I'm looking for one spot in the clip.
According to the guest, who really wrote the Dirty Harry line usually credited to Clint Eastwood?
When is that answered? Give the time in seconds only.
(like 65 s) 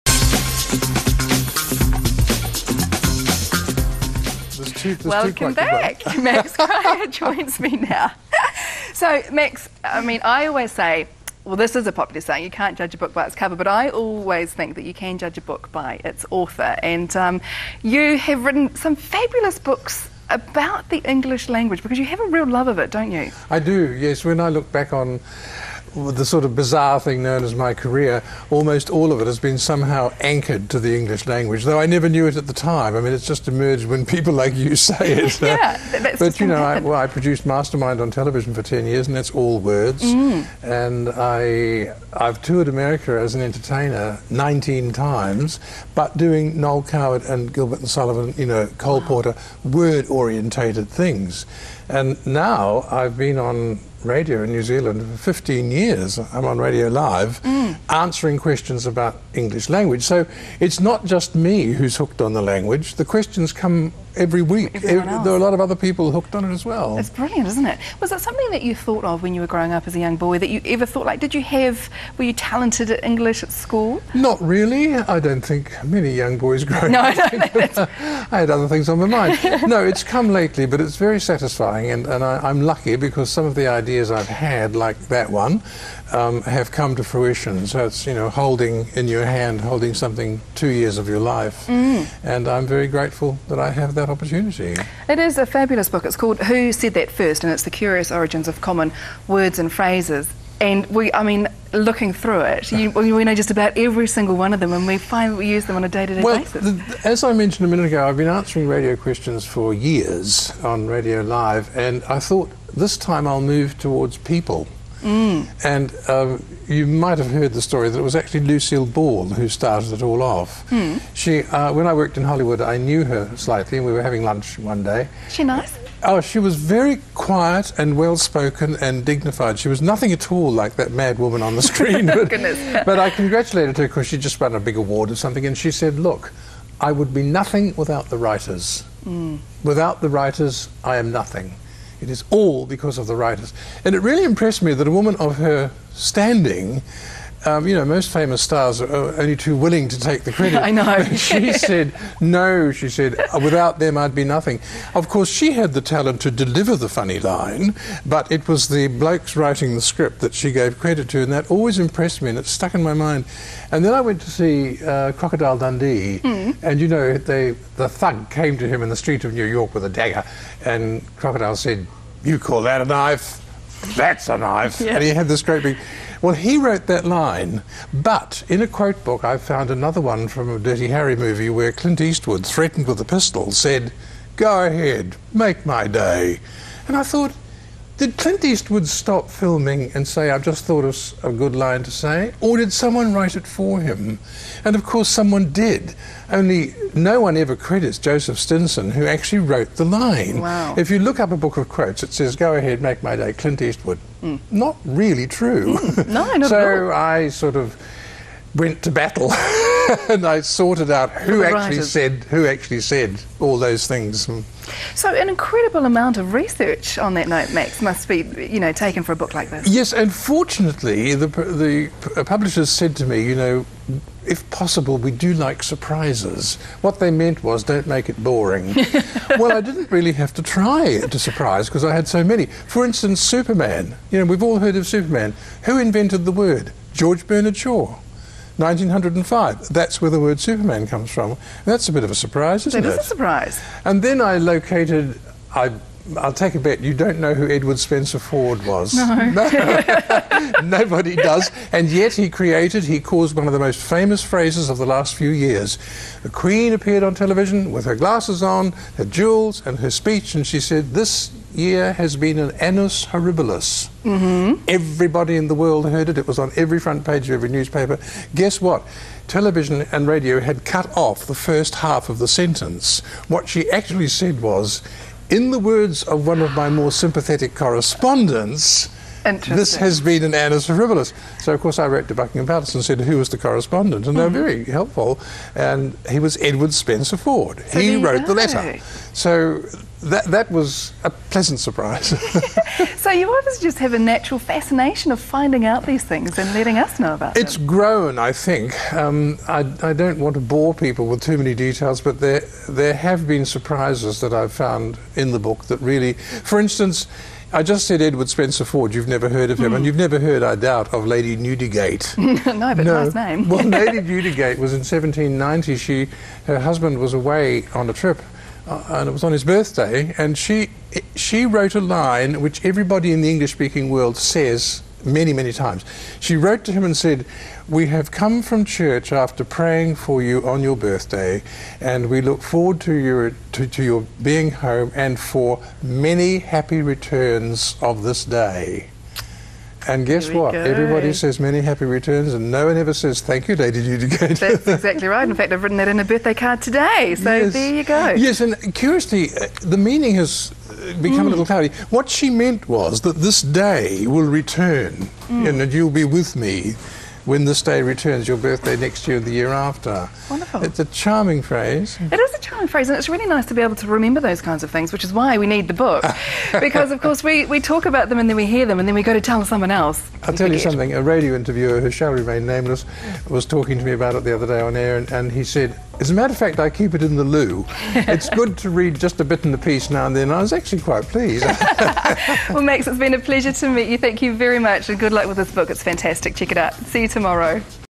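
197 s.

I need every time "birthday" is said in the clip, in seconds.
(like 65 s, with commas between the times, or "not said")
319 s, 330 s, 346 s, 358 s.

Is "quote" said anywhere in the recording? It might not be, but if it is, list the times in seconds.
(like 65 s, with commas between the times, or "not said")
178 s, 201 s.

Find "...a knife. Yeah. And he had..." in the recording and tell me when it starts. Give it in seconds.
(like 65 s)
174 s.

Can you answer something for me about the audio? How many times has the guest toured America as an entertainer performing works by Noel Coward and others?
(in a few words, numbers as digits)
19.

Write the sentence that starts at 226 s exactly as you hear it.
What they meant was, don't make it boring.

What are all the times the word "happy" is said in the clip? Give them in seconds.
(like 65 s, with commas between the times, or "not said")
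336 s, 341 s.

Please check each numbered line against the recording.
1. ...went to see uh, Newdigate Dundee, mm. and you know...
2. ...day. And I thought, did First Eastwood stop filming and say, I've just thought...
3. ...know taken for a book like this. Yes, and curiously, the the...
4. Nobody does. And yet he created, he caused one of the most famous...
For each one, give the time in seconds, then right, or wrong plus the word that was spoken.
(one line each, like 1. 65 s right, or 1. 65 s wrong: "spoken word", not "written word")
1. 164 s wrong: "Crocodile", not "Newdigate"
2. 185 s wrong: "Clint", not "First"
3. 218 s wrong: "fortunately", not "curiously"
4. 250 s right.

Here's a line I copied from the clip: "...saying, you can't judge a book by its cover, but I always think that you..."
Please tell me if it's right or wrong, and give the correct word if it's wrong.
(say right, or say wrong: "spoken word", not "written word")
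right.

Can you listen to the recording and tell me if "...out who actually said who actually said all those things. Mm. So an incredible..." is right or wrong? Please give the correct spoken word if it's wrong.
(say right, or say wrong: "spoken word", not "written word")
right.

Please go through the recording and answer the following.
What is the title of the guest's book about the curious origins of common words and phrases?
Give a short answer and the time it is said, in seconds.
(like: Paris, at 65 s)
Who Said That First, at 96 s.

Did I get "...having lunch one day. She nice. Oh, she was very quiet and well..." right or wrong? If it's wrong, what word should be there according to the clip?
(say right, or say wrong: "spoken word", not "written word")
right.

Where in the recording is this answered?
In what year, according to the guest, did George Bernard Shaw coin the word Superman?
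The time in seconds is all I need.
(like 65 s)
238 s.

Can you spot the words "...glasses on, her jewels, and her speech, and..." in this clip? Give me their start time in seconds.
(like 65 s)
257 s.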